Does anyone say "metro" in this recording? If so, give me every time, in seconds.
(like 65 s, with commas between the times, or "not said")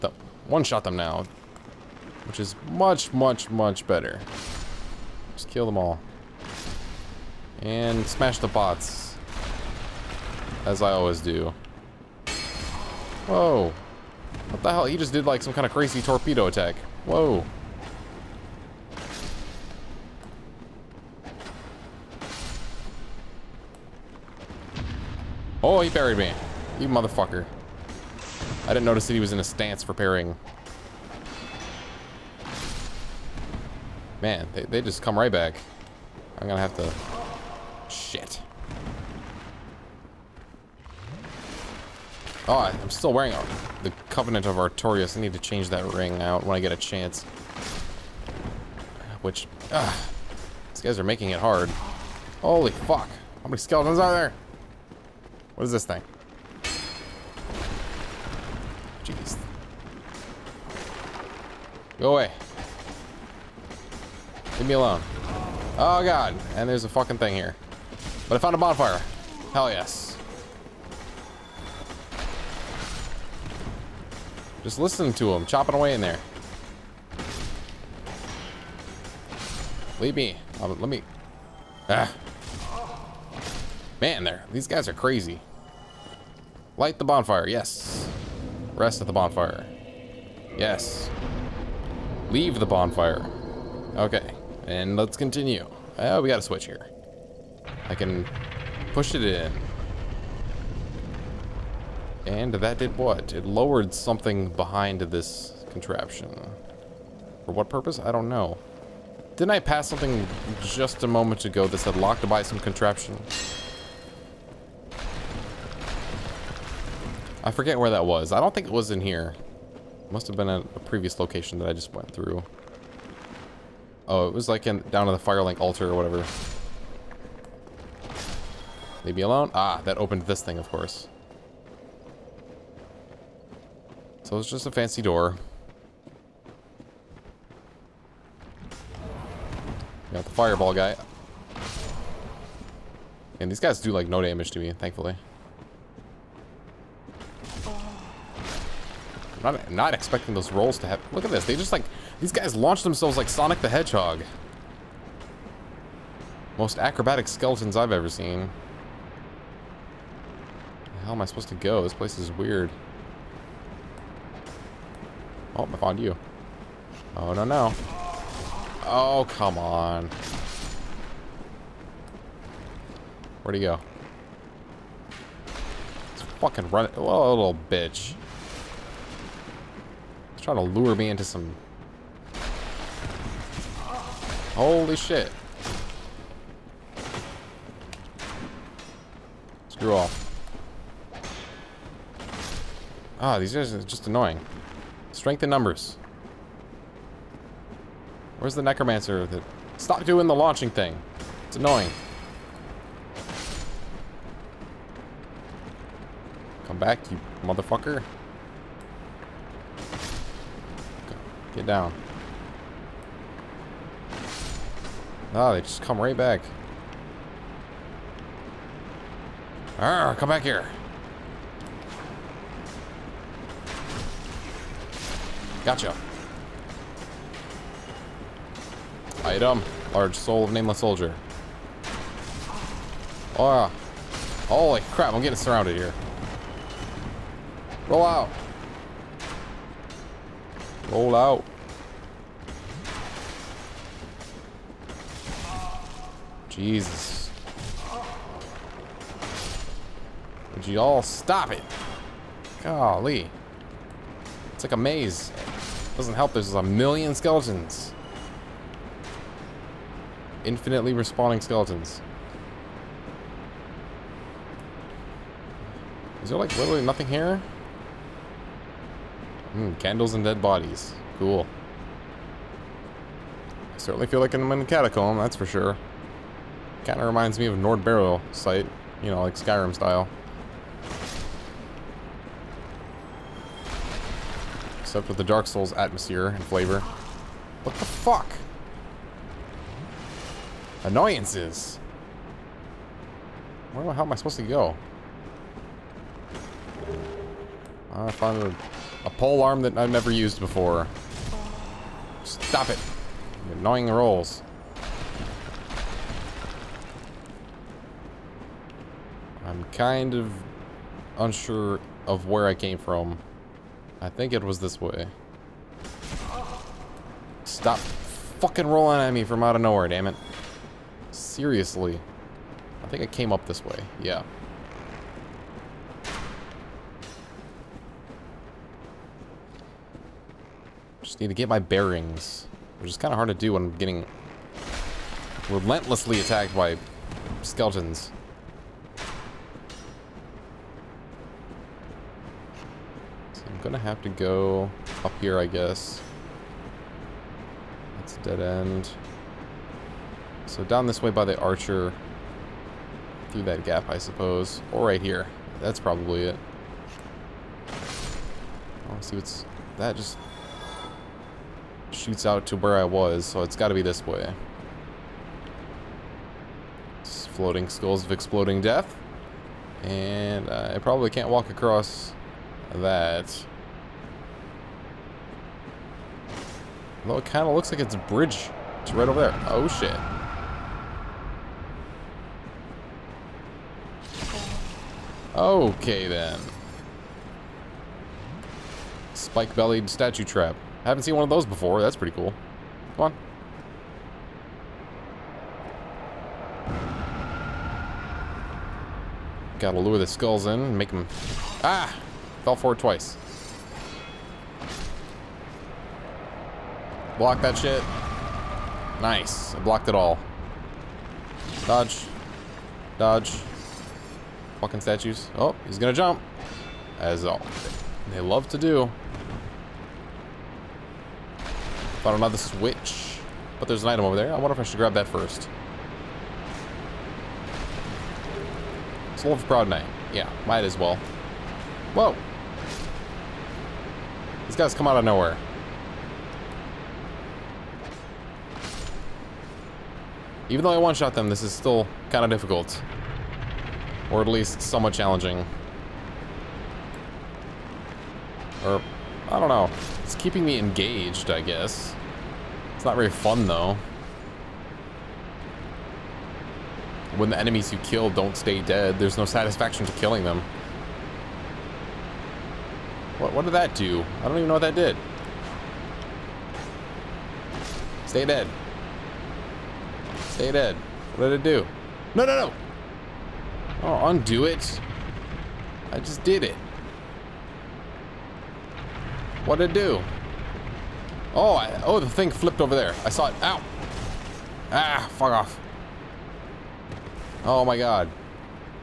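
not said.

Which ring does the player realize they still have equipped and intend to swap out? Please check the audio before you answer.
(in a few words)
Covenant of Artorias.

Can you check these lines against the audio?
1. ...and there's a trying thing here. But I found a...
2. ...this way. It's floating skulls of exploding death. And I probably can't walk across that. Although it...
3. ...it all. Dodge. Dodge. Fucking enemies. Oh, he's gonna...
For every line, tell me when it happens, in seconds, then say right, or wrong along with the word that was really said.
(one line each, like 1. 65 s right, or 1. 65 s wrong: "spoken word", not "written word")
1. 66 s wrong: "fucking", not "trying"
2. 363 s right
3. 409 s wrong: "statues", not "enemies".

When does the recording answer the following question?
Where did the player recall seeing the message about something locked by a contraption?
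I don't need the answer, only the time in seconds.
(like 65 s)
125 s.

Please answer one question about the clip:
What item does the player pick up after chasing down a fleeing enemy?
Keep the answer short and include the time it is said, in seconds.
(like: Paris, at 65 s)
Large soul of nameless soldier, at 229 s.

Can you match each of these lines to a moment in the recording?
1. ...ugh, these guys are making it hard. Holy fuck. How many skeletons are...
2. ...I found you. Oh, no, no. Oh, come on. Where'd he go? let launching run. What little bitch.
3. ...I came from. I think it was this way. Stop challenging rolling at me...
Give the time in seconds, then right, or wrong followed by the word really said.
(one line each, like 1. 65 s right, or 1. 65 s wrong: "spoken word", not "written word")
1. 49 s right
2. 165 s wrong: "fucking", not "launching"
3. 312 s wrong: "fucking", not "challenging".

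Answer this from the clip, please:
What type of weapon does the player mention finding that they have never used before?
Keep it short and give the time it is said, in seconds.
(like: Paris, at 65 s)
Pole arm, at 299 s.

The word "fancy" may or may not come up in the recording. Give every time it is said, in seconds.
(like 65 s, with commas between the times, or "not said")
134 s.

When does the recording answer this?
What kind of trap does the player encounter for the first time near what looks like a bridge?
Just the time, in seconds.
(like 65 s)
389 s.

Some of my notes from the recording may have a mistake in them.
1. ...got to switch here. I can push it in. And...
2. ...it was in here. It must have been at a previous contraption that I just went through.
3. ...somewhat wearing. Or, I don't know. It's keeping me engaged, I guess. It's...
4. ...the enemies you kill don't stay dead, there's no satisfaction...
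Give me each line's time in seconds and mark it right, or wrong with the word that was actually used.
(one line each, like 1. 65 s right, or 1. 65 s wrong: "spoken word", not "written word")
1. 96 s right
2. 118 s wrong: "location", not "contraption"
3. 444 s wrong: "challenging", not "wearing"
4. 457 s right.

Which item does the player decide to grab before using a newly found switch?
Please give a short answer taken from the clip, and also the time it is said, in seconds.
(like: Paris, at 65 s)
Soul of Proud Knight, at 429 s.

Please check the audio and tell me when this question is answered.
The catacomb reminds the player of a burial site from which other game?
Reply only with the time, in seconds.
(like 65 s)
279 s.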